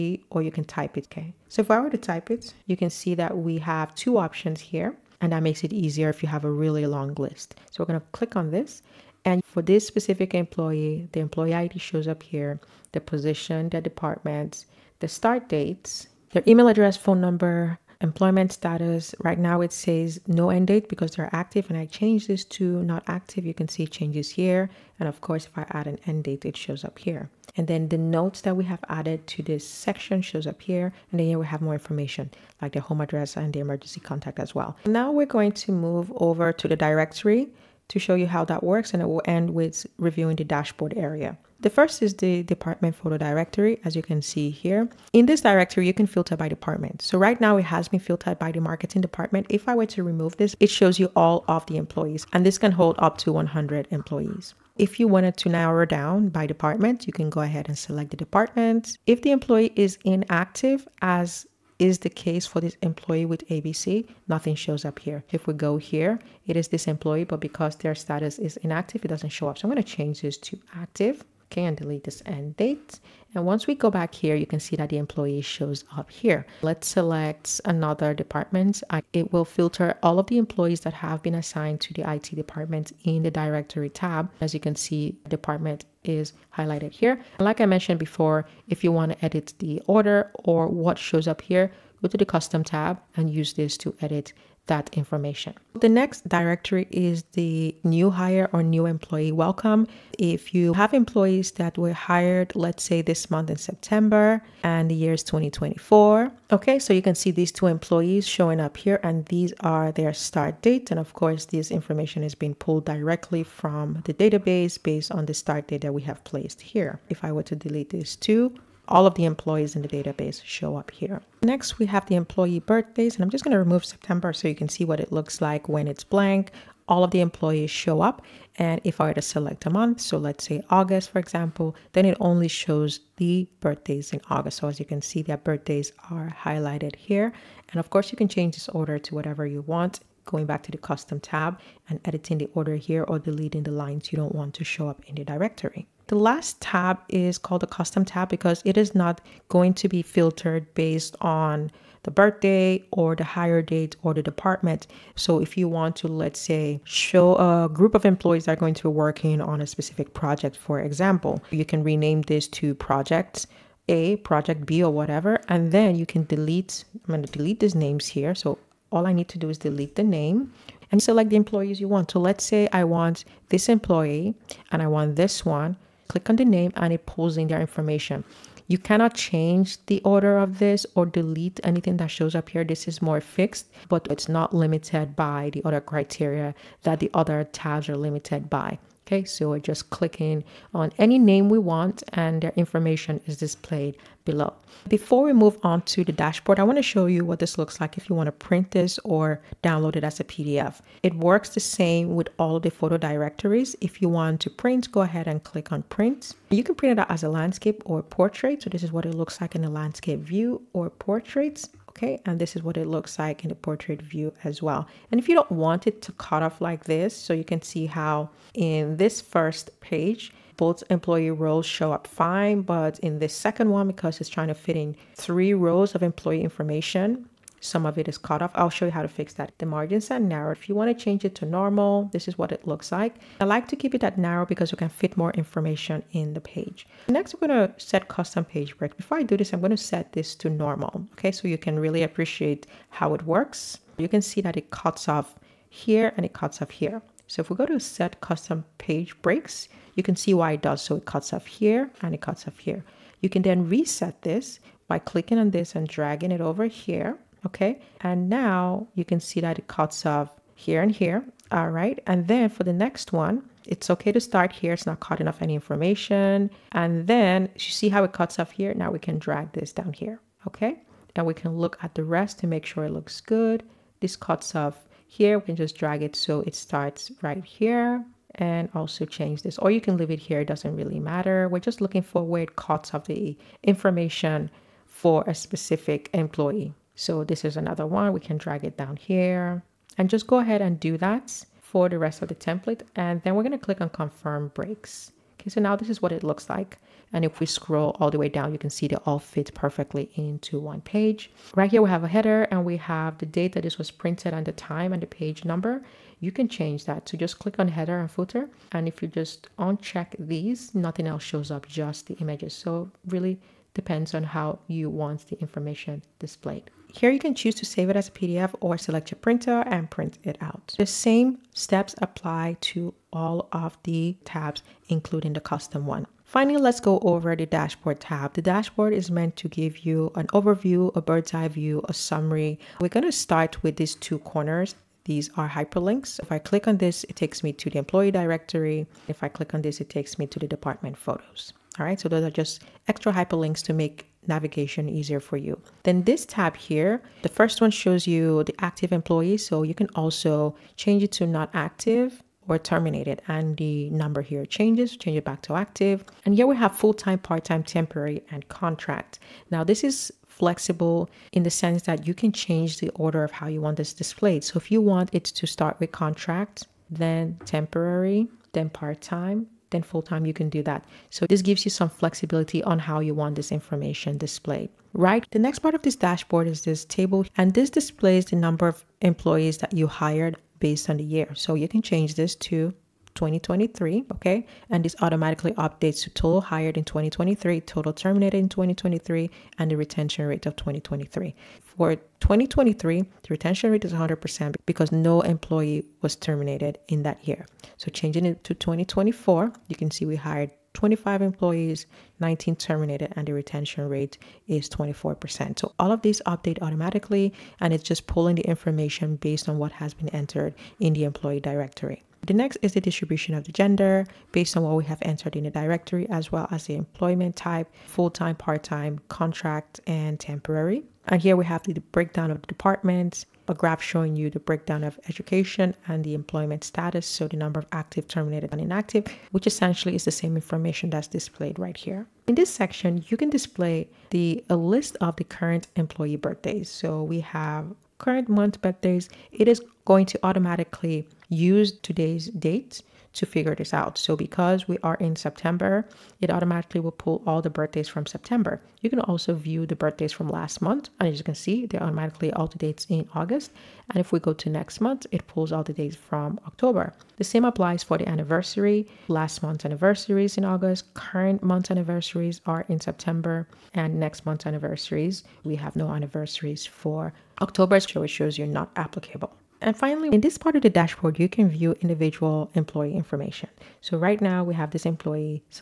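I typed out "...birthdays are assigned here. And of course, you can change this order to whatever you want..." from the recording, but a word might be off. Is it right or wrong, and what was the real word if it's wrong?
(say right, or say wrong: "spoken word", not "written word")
wrong: "highlighted", not "assigned".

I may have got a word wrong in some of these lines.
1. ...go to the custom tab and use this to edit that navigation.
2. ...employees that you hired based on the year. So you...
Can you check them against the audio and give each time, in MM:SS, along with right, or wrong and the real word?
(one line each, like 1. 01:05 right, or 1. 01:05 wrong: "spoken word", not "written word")
1. 01:32 wrong: "information", not "navigation"
2. 06:19 right.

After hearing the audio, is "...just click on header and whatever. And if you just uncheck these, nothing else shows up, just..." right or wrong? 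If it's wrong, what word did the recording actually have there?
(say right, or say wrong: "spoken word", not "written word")
wrong: "footer", not "whatever".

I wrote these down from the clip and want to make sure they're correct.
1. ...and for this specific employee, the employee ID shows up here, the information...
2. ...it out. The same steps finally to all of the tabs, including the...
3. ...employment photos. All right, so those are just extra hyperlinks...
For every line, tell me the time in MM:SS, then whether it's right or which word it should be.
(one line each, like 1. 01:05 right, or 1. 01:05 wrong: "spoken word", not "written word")
1. 00:09 wrong: "position", not "information"
2. 05:20 wrong: "apply", not "finally"
3. 05:40 wrong: "department", not "employment".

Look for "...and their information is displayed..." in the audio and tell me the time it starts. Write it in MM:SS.
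03:12.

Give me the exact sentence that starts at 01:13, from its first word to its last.
And once we go back here, you can see that the employee shows up here.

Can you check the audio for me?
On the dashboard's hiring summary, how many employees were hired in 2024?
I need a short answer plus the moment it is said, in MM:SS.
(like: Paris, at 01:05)
25, at 06:40.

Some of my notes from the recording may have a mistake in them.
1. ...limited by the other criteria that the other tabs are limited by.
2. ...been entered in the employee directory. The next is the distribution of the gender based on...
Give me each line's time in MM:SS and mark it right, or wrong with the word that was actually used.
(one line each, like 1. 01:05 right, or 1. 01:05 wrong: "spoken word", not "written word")
1. 03:04 right
2. 06:49 right.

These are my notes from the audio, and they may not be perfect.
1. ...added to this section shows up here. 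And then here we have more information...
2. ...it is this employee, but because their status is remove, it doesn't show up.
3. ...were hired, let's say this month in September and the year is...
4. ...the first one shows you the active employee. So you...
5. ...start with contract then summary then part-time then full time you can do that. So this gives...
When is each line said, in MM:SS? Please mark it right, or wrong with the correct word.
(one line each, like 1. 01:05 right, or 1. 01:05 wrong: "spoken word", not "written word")
1. 00:28 right
2. 01:06 wrong: "inactive", not "remove"
3. 01:41 right
4. 05:47 right
5. 06:05 wrong: "temporary", not "summary".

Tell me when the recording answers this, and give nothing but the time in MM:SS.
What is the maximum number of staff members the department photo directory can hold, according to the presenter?
00:53.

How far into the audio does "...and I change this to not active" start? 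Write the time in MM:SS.
00:21.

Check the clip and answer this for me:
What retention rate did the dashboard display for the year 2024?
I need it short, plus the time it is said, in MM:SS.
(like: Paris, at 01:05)
24%, at 06:43.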